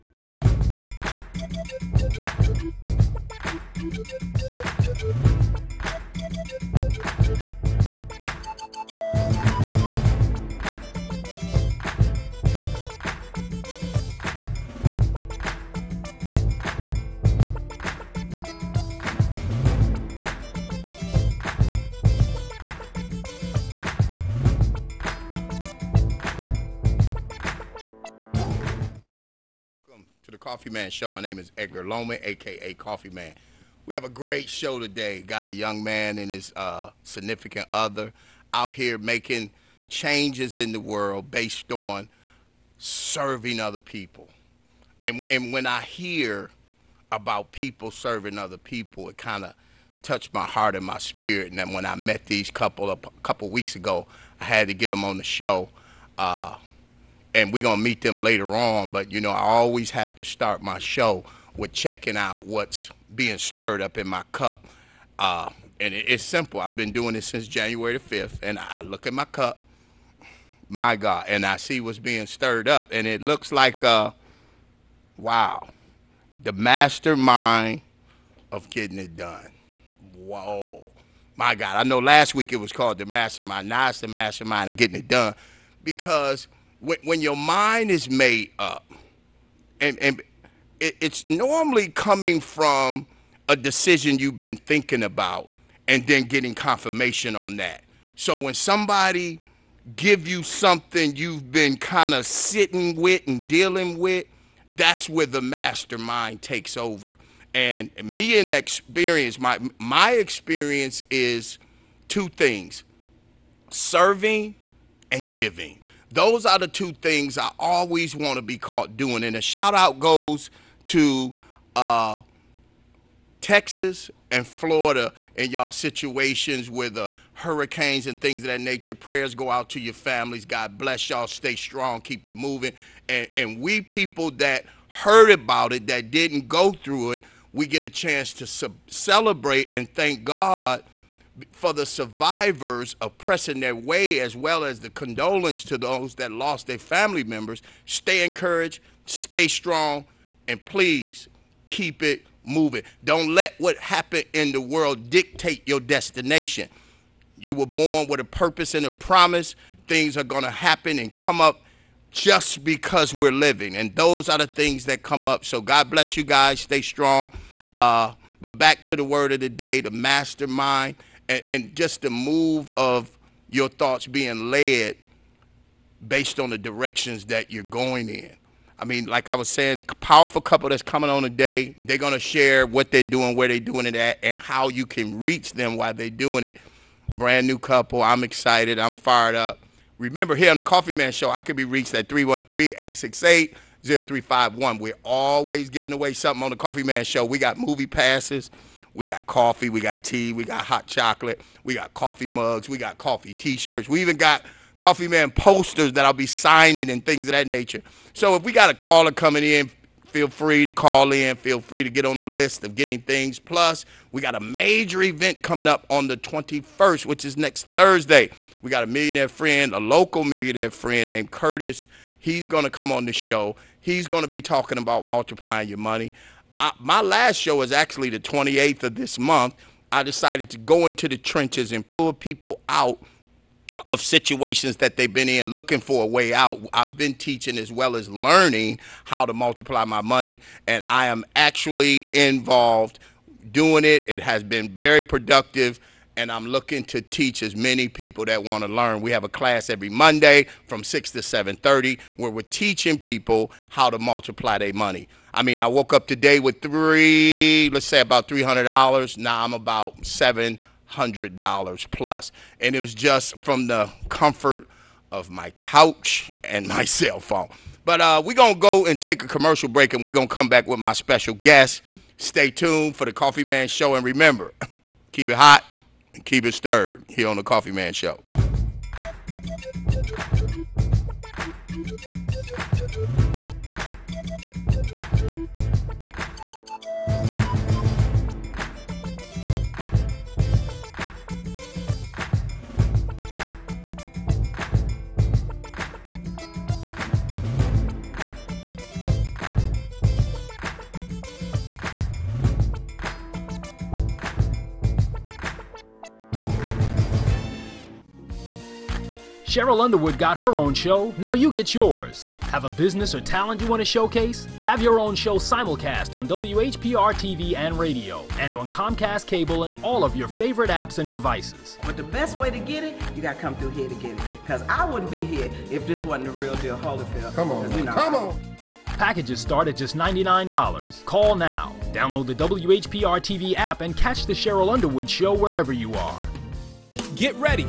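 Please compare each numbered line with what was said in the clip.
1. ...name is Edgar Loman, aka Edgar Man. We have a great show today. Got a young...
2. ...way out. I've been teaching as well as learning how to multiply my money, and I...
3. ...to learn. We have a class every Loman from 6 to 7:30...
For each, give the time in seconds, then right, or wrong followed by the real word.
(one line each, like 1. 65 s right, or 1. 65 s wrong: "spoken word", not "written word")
1. 31 s wrong: "Coffee", not "Edgar"
2. 236 s right
3. 248 s wrong: "Monday", not "Loman".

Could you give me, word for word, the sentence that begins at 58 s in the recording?
But you know, I always have to start my show with checking out what's being stirred up in my cup.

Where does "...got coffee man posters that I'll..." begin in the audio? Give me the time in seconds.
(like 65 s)
204 s.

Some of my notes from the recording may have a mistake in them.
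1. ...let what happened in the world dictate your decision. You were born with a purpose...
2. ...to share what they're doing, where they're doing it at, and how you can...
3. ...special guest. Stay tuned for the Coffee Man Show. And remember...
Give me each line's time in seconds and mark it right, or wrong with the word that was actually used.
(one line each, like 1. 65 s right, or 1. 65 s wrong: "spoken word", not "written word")
1. 153 s wrong: "destination", not "decision"
2. 182 s right
3. 270 s right.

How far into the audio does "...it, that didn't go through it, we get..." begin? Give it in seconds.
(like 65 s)
135 s.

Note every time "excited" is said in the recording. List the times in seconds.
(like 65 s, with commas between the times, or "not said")
188 s.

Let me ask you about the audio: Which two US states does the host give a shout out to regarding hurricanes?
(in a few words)
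Texas and Florida.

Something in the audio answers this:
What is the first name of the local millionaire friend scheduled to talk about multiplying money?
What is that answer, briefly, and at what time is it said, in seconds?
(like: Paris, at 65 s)
Curtis, at 221 s.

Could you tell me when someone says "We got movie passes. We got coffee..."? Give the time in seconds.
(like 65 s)
197 s.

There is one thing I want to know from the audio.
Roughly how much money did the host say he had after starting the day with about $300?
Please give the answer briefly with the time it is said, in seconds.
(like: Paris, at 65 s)
$700 plus, at 260 s.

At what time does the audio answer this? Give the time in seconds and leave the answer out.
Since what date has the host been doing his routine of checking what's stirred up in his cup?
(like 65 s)
67 s.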